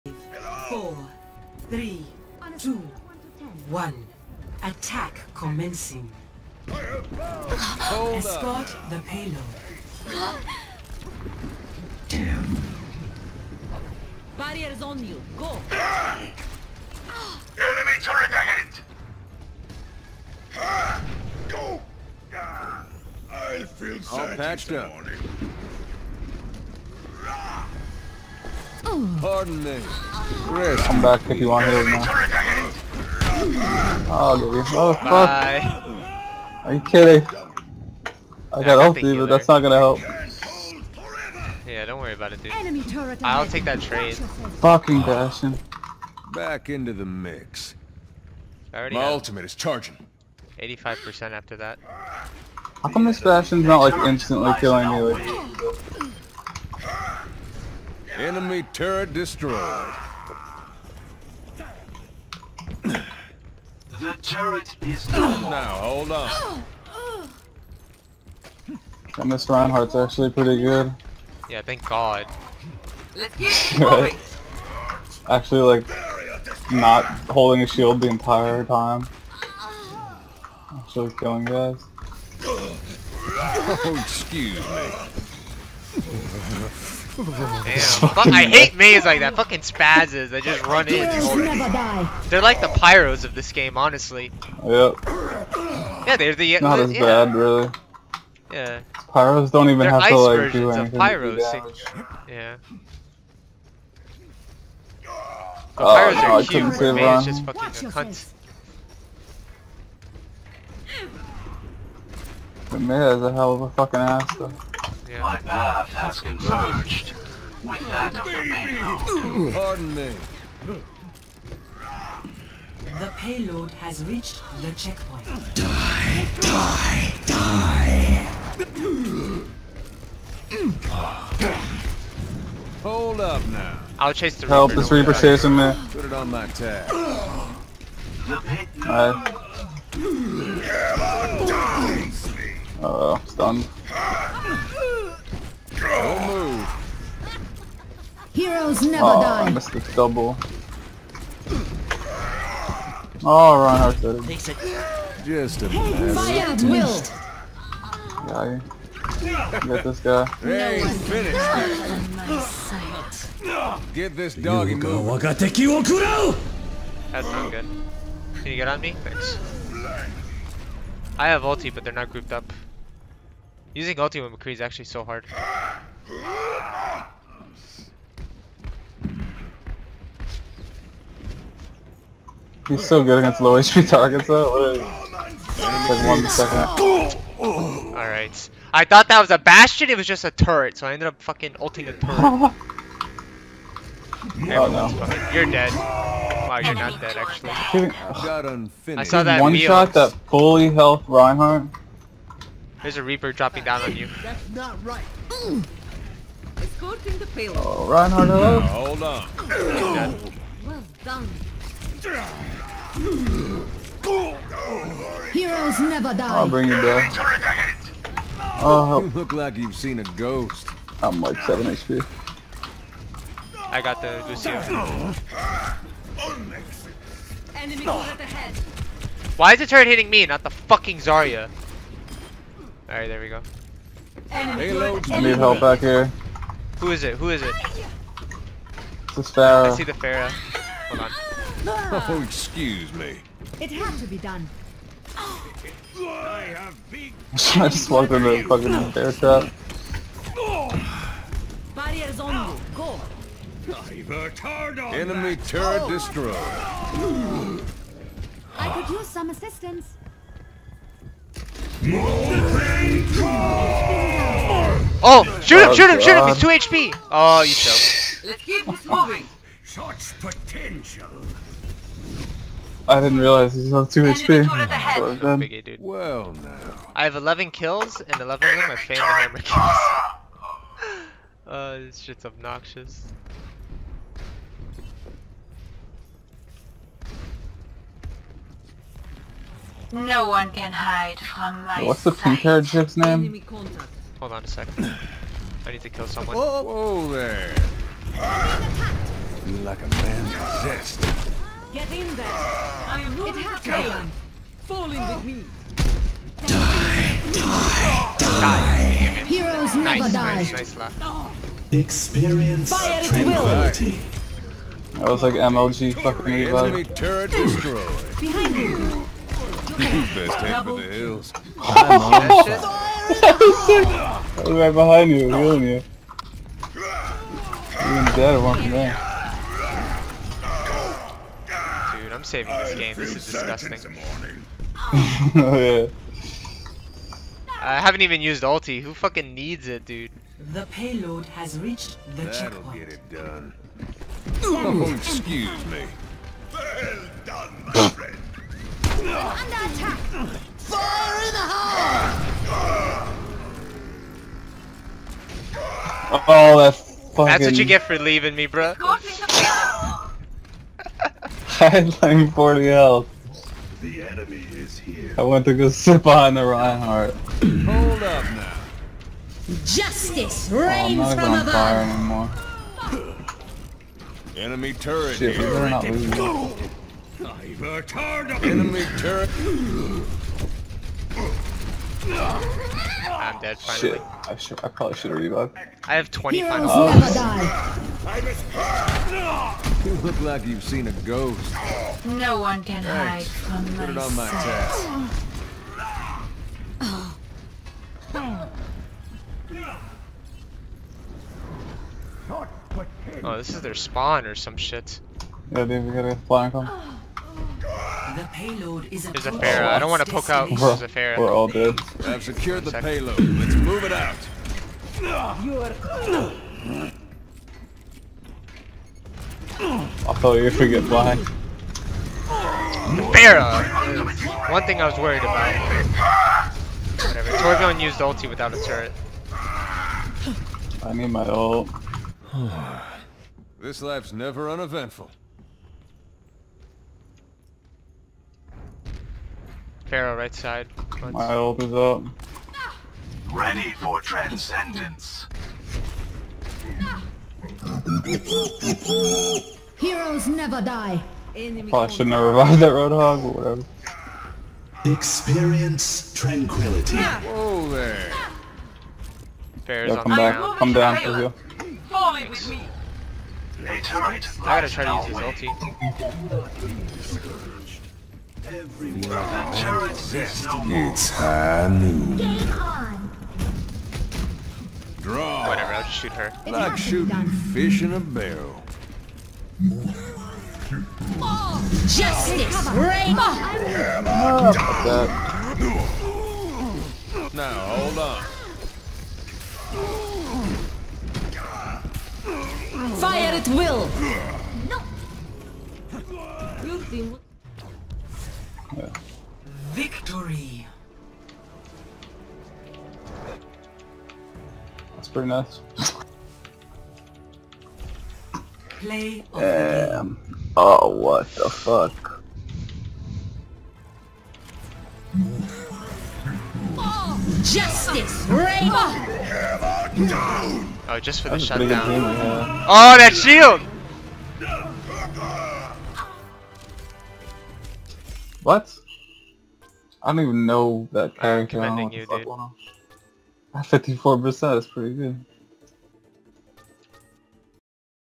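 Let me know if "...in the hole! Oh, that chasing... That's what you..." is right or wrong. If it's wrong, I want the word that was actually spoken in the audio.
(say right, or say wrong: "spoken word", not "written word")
wrong: "fucking", not "chasing".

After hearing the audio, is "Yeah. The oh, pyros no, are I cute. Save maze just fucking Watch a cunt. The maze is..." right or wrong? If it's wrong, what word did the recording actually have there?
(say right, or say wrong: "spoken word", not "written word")
right.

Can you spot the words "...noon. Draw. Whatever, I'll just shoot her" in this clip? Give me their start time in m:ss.
7:51.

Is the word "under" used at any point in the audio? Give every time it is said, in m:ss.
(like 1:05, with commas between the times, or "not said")
5:49.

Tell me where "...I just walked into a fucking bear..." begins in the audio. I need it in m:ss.
4:05.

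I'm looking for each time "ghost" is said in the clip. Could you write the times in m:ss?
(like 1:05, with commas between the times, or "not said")
3:40, 6:31.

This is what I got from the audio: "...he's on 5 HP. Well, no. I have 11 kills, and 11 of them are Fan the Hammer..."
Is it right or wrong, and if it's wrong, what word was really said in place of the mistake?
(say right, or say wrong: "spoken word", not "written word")
wrong: "2", not "5".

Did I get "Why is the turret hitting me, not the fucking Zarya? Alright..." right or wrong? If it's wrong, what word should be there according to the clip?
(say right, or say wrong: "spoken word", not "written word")
right.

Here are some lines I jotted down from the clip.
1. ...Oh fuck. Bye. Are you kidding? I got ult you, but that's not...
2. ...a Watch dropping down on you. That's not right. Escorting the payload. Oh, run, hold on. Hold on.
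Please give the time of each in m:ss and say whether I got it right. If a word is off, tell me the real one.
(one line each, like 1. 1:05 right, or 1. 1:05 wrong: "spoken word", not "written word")
1. 0:34 right
2. 3:22 wrong: "Reaper", not "Watch".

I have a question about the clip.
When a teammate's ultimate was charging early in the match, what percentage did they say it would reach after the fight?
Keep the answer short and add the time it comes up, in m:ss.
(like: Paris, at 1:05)
85%, at 0:50.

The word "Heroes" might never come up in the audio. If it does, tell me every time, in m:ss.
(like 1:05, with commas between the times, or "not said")
2:28, 3:35, 5:09, 6:26, 7:29.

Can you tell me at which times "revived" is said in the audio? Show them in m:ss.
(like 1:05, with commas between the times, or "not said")
6:25, 7:32.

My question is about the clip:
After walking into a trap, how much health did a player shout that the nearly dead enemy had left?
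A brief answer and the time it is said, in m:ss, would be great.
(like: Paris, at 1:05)
2 HP, at 4:26.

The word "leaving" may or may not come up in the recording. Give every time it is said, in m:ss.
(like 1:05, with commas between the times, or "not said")
5:57.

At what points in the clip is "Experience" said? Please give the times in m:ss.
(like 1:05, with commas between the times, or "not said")
5:11, 7:34.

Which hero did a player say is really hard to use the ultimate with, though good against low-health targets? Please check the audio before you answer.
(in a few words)
McCree.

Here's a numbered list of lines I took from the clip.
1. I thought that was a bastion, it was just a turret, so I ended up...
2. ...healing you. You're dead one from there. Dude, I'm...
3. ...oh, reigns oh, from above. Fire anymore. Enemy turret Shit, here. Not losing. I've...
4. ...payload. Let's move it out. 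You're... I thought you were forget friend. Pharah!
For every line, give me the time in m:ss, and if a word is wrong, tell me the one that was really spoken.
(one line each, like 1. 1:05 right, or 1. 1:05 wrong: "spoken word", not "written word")
1. 3:08 right
2. 5:25 right
3. 6:10 right
4. 6:52 wrong: "blind", not "friend".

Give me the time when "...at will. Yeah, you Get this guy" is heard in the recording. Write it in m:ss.
2:36.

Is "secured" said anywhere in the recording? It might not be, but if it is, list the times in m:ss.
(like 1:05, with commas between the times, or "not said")
6:52.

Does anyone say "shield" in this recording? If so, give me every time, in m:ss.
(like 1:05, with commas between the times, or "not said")
1:17, 8:43.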